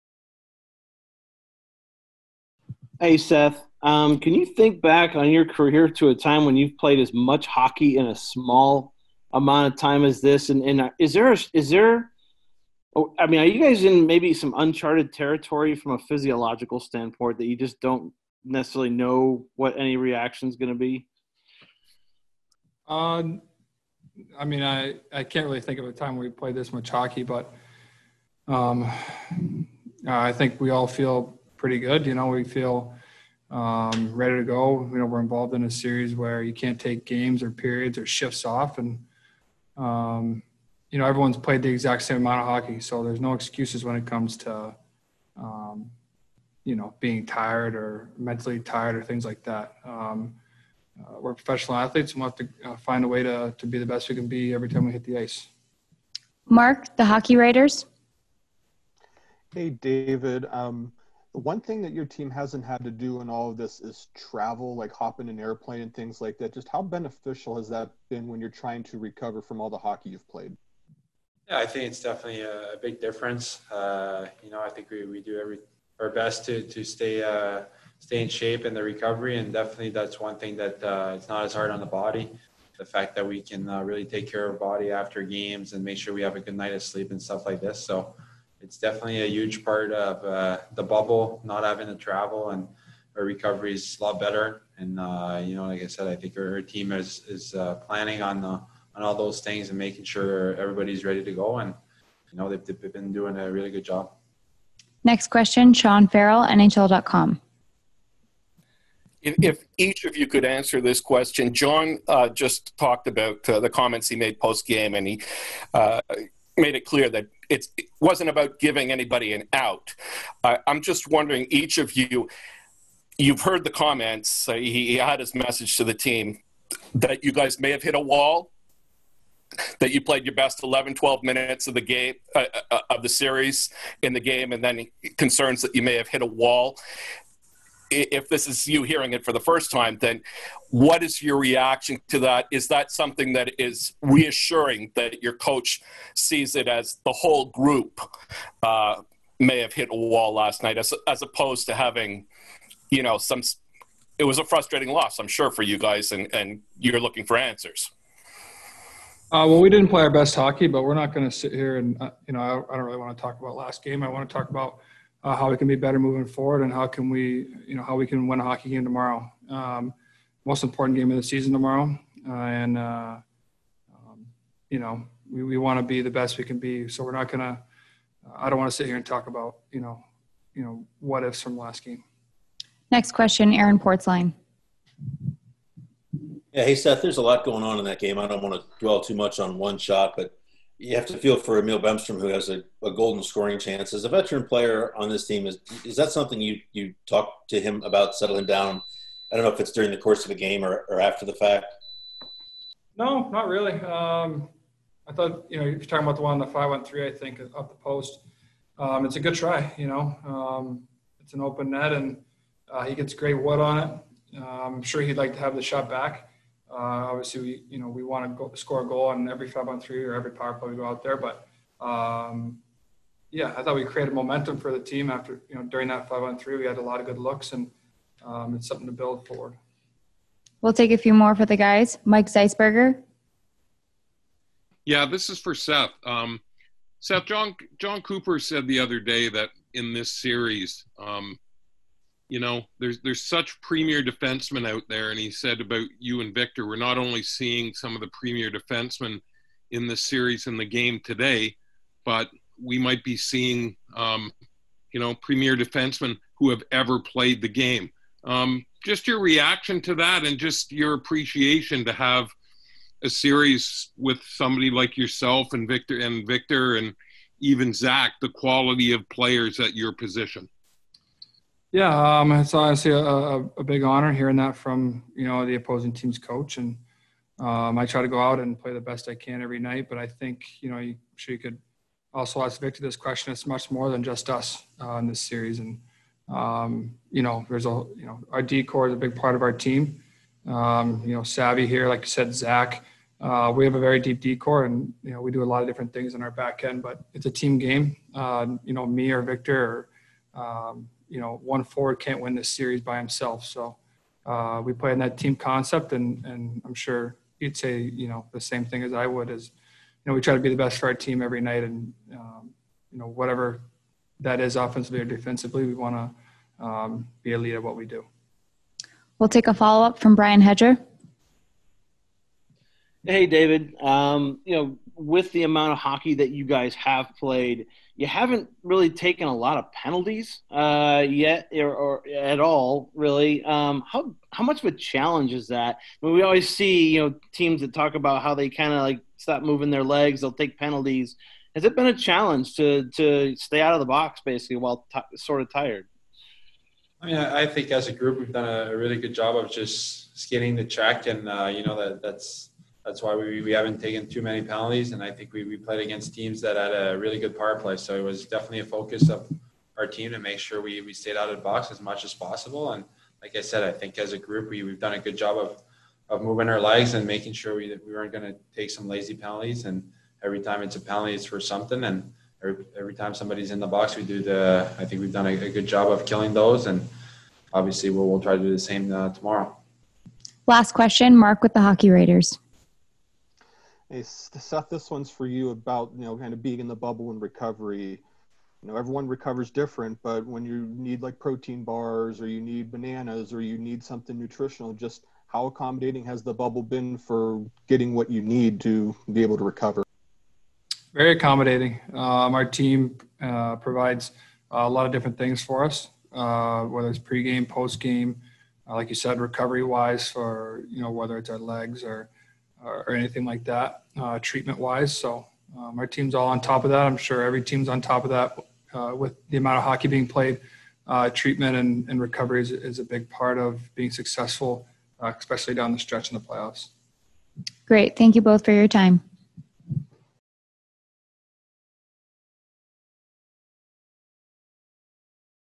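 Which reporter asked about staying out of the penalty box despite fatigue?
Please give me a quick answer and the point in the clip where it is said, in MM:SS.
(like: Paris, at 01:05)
Brian Hedger, at 05:20.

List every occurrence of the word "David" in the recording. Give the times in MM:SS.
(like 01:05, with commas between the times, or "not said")
00:59, 05:23.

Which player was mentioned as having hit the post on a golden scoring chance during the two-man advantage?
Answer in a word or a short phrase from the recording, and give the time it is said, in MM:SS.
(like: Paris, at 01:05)
Emil Bemstrom, at 03:11.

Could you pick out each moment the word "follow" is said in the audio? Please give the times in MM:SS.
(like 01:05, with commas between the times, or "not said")
05:19.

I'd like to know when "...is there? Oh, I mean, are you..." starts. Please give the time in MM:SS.
00:11.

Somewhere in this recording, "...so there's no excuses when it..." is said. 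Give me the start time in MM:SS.
00:42.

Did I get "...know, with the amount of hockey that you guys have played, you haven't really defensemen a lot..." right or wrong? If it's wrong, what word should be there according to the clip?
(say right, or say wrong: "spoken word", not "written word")
wrong: "taken", not "defensemen".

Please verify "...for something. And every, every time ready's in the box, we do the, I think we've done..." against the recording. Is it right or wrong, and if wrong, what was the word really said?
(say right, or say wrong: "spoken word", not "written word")
wrong: "somebody", not "ready".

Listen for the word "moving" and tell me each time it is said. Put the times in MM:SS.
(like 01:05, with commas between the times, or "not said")
02:45, 05:39, 06:06.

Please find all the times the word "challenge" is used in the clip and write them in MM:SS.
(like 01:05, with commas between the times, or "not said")
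05:34, 05:41.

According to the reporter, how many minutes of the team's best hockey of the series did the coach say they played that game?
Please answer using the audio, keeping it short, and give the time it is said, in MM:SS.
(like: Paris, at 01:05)
11 or 12 minutes, at 02:10.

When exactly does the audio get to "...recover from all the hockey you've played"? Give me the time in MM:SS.
01:08.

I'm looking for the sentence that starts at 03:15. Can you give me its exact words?
Is is that something you you talk to him about settling down?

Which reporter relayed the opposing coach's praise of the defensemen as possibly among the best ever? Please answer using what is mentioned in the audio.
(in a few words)
Mike Zeisberger.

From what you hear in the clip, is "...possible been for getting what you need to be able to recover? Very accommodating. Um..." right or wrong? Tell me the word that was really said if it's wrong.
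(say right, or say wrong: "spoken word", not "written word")
wrong: "bubble", not "possible".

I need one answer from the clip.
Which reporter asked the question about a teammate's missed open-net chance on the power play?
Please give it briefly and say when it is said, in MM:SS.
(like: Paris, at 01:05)
Aaron Portzline, at 03:03.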